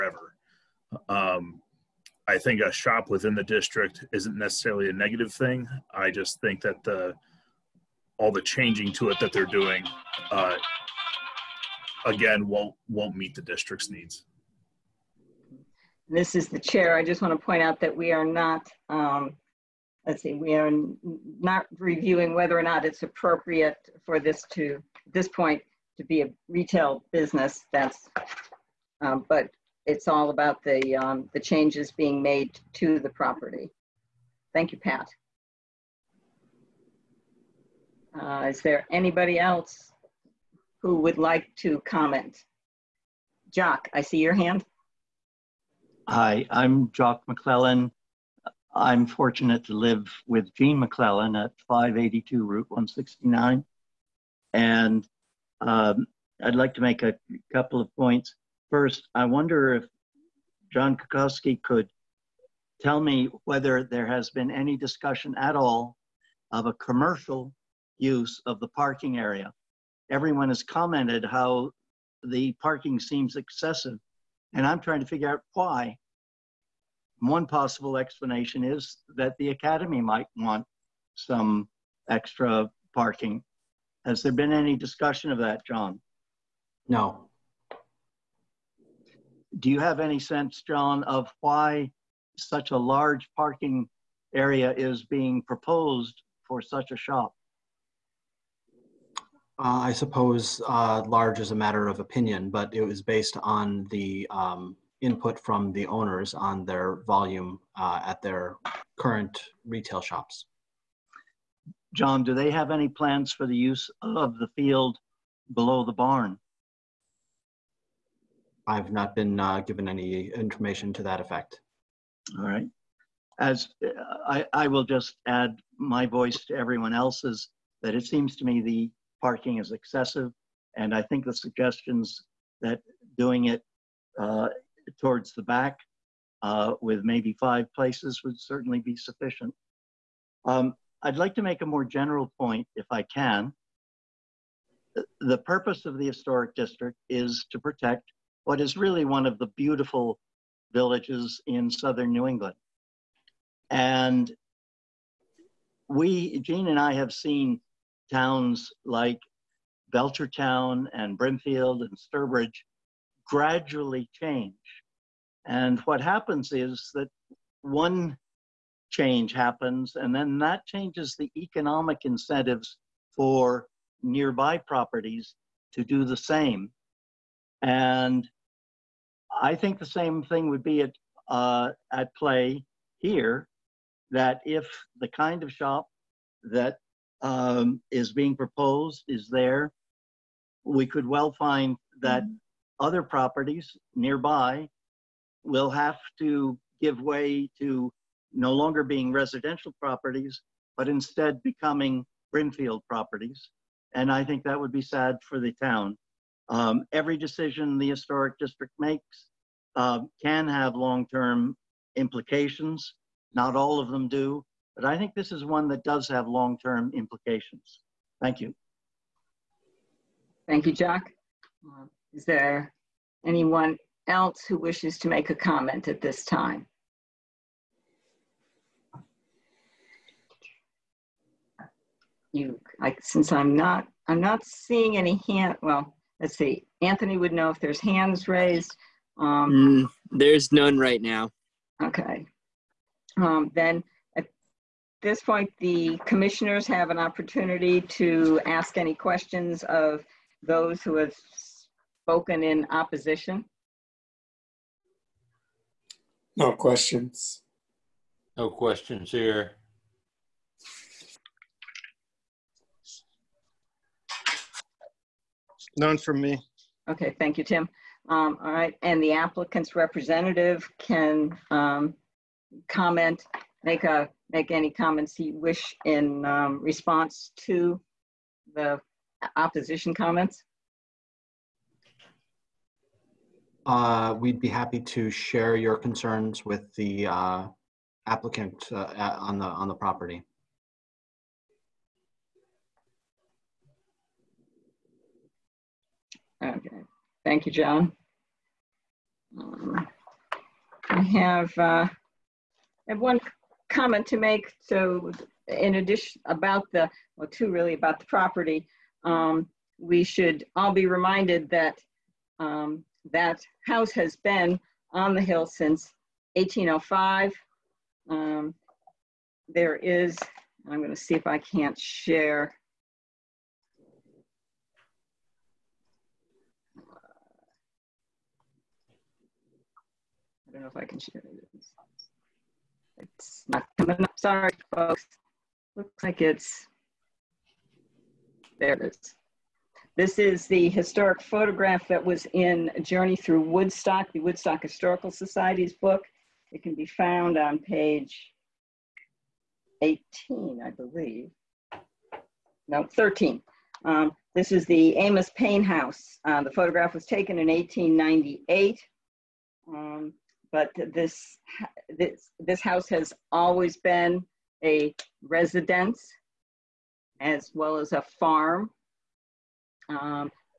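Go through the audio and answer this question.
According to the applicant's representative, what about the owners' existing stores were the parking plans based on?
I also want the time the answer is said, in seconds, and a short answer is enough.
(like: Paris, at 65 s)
Their volume, at 106 s.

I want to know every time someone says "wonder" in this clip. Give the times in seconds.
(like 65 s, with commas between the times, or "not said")
59 s.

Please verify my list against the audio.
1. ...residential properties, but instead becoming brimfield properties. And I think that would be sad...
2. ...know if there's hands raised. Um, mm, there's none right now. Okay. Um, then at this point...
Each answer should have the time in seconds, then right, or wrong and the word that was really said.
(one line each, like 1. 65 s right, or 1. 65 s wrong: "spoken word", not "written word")
1. 199 s right
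2. 237 s right.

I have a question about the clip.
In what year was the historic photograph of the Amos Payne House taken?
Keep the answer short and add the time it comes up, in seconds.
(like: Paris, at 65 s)
1898, at 357 s.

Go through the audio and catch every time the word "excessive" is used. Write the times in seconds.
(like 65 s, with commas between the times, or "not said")
73 s, 129 s.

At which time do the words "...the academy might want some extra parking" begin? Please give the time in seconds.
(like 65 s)
79 s.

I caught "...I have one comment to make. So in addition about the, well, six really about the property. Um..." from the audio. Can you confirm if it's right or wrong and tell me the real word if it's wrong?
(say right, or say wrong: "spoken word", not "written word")
wrong: "two", not "six".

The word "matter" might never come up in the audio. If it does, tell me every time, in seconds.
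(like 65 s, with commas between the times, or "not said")
101 s.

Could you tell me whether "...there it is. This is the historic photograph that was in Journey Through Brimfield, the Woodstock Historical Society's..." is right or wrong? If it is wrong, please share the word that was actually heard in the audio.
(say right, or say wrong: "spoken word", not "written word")
wrong: "Woodstock", not "Brimfield".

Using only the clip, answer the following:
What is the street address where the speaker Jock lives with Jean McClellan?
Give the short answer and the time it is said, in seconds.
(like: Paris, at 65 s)
582 Route 169, at 51 s.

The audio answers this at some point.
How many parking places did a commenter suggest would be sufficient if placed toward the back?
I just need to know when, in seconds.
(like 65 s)
137 s.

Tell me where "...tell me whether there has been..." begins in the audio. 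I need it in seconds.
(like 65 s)
62 s.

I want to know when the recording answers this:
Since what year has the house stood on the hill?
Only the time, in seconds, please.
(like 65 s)
316 s.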